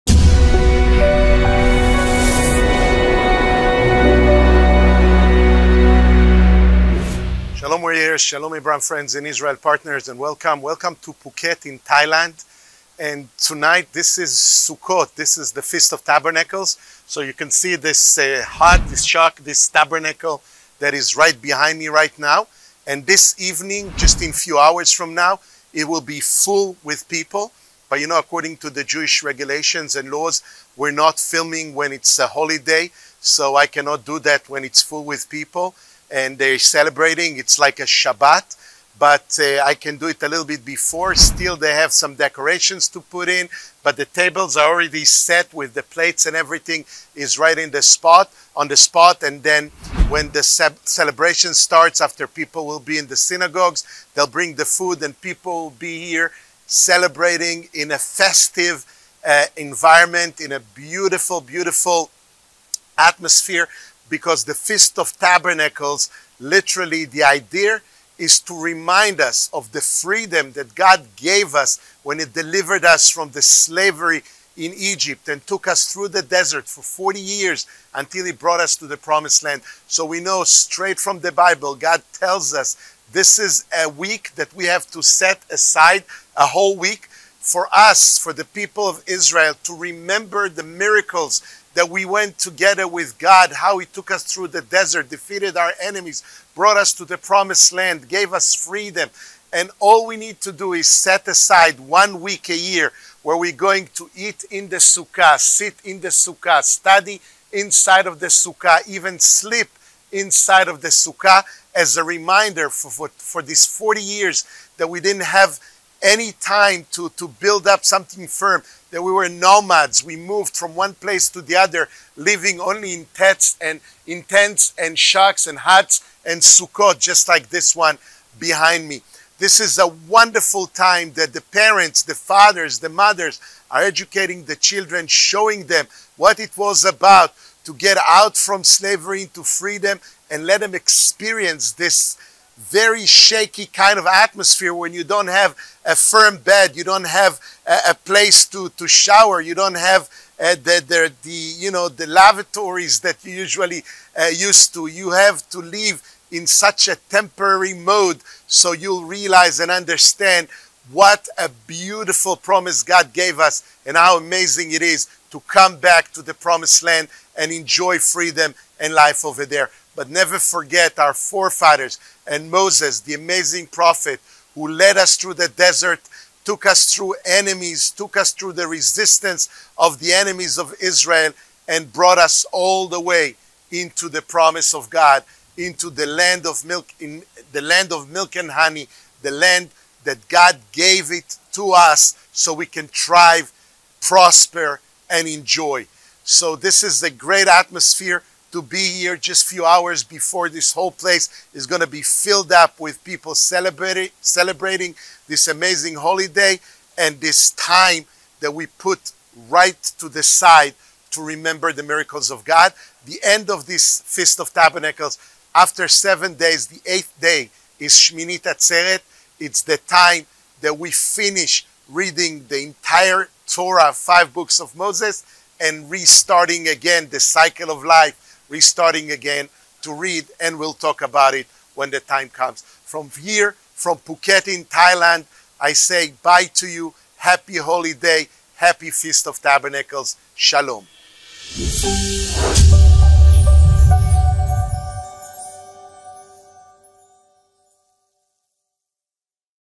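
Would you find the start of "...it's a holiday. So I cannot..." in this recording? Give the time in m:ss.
0:31.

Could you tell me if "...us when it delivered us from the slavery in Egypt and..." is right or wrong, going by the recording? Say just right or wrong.
right.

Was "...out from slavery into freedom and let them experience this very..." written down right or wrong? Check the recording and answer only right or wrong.
right.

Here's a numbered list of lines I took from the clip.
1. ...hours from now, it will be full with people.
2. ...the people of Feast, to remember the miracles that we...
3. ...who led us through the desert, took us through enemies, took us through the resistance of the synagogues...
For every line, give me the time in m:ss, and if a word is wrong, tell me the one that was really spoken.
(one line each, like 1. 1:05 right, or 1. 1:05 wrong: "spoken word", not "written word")
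1. 0:24 right
2. 1:28 wrong: "Israel", not "Feast"
3. 2:54 wrong: "enemies", not "synagogues".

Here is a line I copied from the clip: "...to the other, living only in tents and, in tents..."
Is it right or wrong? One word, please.
right.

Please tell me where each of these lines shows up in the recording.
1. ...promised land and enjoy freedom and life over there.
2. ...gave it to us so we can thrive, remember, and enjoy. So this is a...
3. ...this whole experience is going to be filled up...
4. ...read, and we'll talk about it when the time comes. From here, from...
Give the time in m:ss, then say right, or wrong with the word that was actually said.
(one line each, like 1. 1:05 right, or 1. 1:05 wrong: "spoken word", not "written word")
1. 2:46 right
2. 3:10 wrong: "prosper", not "remember"
3. 3:20 wrong: "place", not "experience"
4. 3:49 right.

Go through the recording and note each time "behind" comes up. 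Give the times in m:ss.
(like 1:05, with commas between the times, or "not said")
0:21, 2:08.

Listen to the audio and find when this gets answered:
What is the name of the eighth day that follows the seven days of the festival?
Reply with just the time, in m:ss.
3:37.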